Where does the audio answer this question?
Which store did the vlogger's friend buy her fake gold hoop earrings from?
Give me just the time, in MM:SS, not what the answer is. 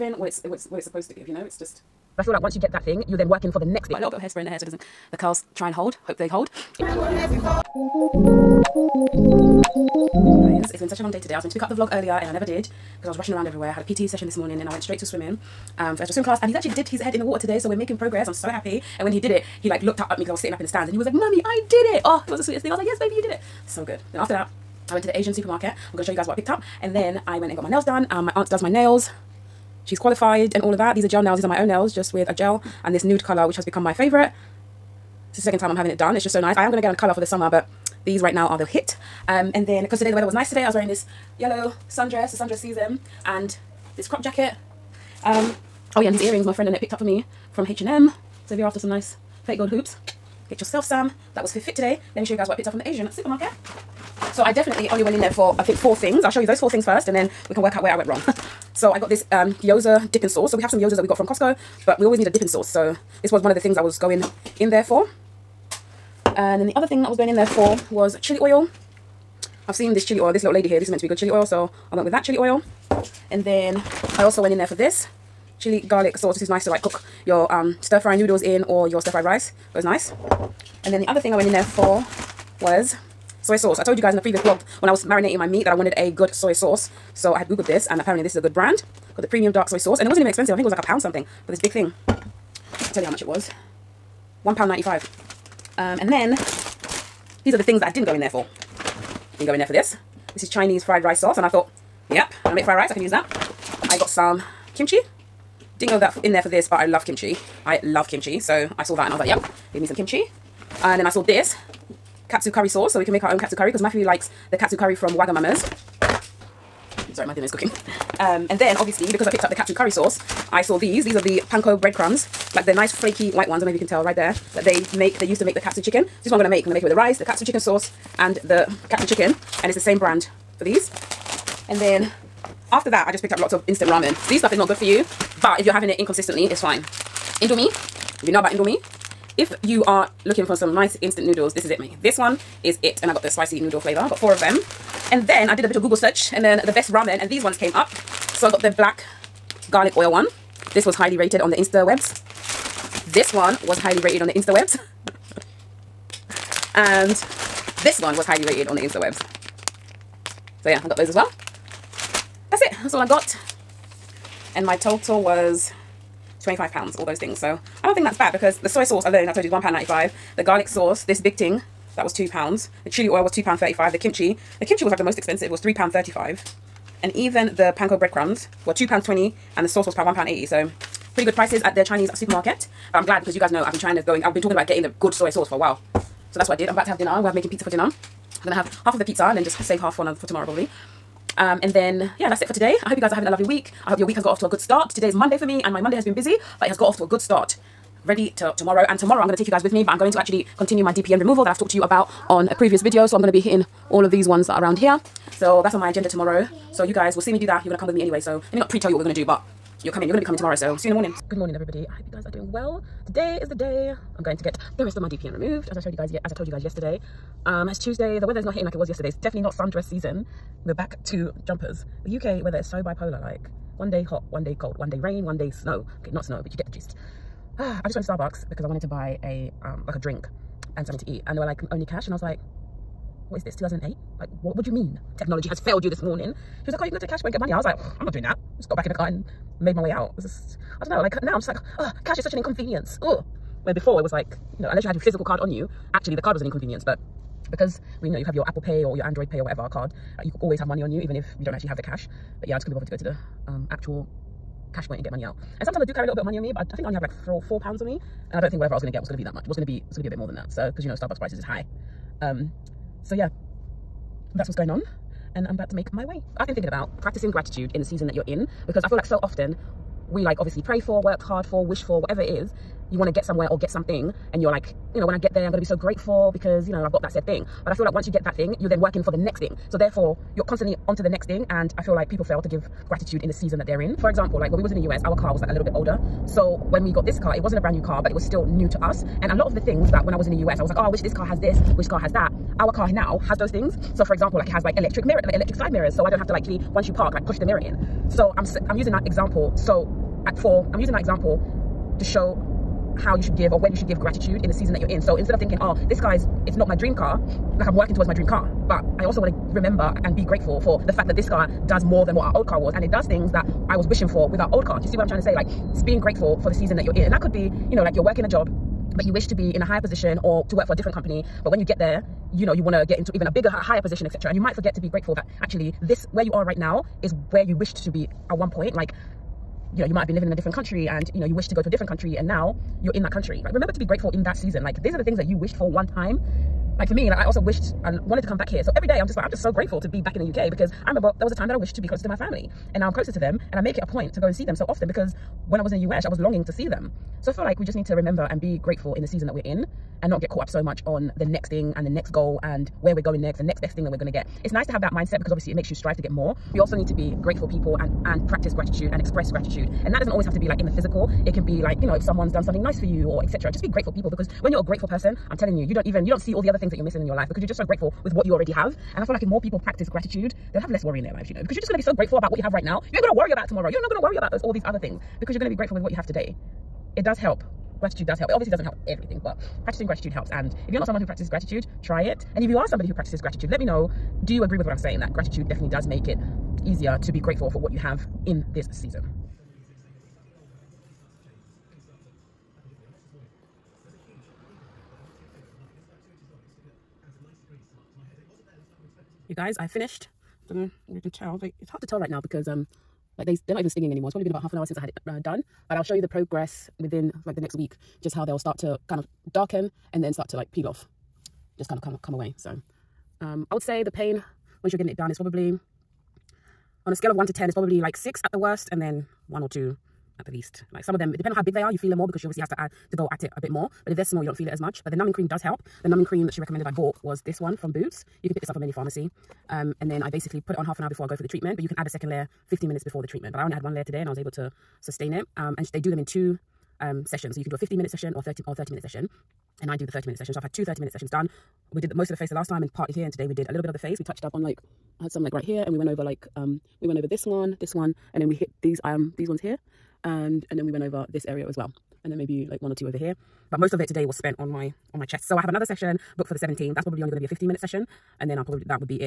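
00:47.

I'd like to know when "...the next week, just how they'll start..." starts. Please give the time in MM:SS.
06:47.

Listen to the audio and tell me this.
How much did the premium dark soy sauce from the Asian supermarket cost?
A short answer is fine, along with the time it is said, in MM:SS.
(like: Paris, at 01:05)
£1.95, at 01:34.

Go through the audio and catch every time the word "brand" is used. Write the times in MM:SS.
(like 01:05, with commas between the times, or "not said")
01:28, 02:09, 04:47.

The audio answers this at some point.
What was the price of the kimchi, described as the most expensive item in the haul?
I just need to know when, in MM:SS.
02:55.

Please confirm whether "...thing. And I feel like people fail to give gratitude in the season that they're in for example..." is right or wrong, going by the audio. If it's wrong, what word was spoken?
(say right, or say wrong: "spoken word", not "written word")
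right.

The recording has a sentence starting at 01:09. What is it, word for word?
I've seen this chili oil, this little lady here.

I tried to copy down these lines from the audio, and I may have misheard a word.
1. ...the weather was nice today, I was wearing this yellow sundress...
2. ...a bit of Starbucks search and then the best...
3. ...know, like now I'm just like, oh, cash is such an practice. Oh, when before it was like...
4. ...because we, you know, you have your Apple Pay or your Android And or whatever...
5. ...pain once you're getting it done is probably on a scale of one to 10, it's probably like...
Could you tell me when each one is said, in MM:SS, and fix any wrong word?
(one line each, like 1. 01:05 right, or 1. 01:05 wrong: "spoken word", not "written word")
1. 00:40 right
2. 02:25 wrong: "Google", not "Starbucks"
3. 04:00 wrong: "inconvenience", not "practice"
4. 04:07 wrong: "Pay", not "And"
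5. 06:53 right.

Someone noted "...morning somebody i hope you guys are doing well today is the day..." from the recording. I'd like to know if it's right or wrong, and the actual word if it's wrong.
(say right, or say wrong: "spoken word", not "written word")
wrong: "everybody", not "somebody".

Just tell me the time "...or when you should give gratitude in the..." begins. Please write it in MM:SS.
05:03.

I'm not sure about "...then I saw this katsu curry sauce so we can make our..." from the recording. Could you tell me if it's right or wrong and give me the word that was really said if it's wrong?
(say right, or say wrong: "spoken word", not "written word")
right.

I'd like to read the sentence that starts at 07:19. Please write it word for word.
And I do the 30 minute session.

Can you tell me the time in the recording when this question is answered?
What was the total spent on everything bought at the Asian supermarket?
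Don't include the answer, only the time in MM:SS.
02:46.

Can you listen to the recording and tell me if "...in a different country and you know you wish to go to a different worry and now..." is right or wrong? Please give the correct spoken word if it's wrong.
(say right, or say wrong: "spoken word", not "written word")
wrong: "country", not "worry".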